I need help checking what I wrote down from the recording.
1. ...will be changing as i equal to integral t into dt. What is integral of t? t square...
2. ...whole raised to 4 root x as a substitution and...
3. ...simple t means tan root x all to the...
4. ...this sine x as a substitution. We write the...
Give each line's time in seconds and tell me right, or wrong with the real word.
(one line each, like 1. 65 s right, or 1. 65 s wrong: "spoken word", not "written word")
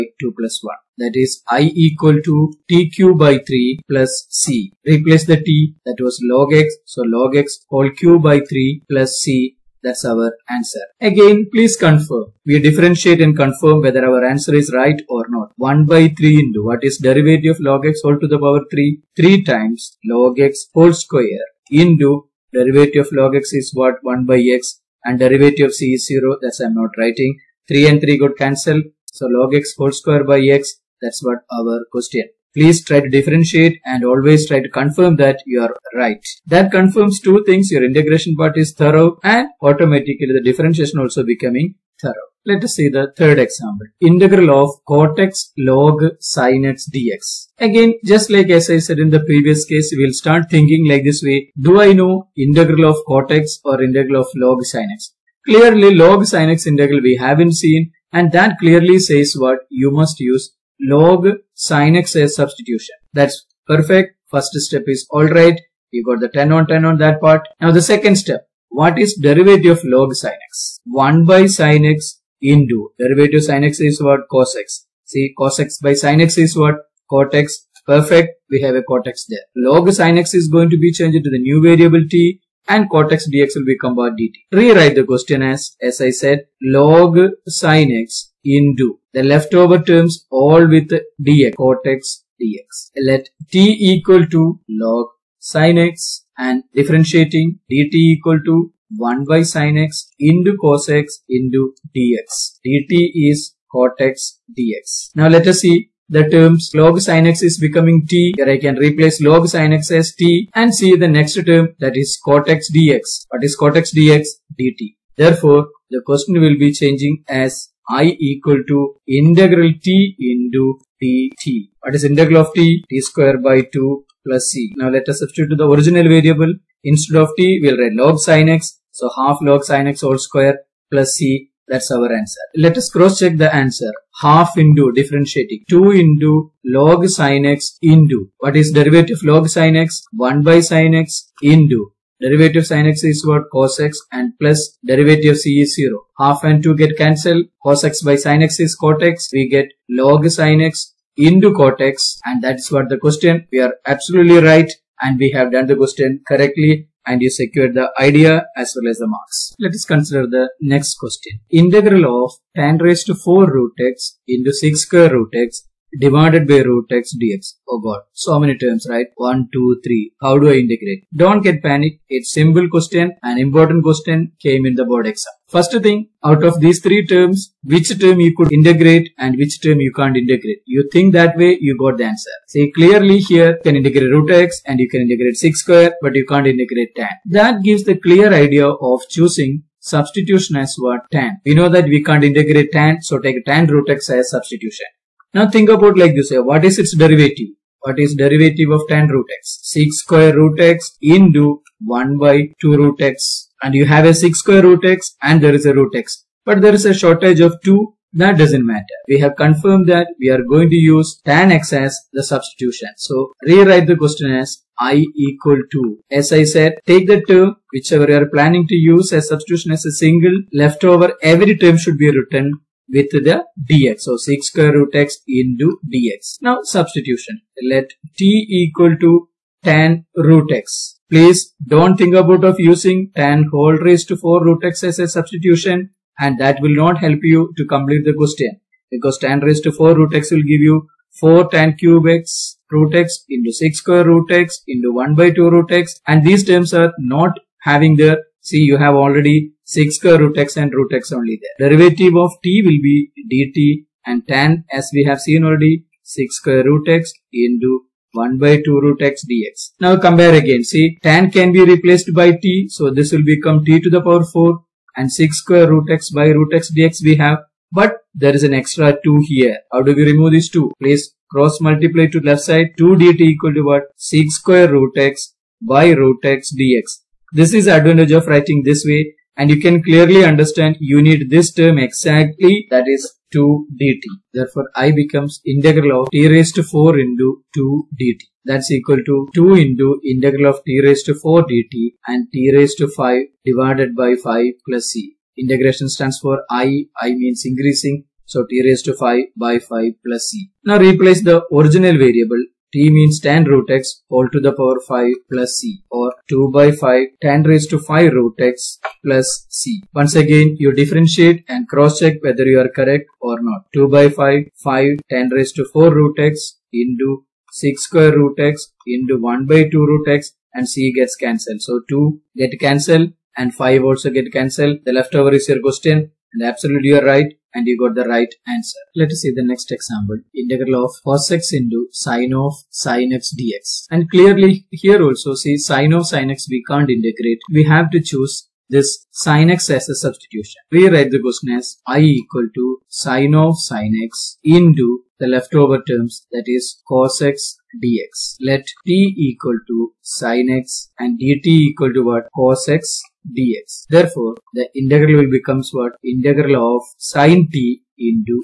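1. 116 s right
2. 233 s right
3. 302 s wrong: "variable", not "simple"
4. 338 s right.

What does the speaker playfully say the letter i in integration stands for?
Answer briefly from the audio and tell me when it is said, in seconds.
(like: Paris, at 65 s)
increasing, at 296 s.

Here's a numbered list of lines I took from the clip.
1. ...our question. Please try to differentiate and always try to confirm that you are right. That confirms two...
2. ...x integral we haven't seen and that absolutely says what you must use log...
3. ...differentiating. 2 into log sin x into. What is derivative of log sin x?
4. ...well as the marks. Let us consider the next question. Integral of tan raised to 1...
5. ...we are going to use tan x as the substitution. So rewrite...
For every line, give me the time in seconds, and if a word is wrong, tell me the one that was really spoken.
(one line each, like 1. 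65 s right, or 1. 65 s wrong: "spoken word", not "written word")
1. 31 s right
2. 56 s wrong: "clearly", not "absolutely"
3. 134 s right
4. 158 s wrong: "4", not "1"
5. 210 s right.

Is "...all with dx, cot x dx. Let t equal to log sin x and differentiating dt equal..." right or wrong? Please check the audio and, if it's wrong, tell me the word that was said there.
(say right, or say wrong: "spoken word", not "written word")
right.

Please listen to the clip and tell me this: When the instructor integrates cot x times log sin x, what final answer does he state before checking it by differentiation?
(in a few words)
half log sin x whole square plus c.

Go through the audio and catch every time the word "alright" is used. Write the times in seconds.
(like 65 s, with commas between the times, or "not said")
65 s.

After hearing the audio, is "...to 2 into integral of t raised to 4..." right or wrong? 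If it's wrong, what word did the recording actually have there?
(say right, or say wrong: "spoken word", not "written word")
right.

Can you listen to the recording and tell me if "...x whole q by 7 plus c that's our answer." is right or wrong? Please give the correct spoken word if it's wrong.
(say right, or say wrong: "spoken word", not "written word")
wrong: "3", not "7".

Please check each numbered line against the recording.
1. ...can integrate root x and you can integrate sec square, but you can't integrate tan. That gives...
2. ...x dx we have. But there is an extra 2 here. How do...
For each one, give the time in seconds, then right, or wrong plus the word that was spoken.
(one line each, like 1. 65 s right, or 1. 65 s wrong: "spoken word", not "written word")
1. 183 s right
2. 266 s right.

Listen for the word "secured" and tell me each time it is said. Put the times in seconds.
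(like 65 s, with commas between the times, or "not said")
157 s.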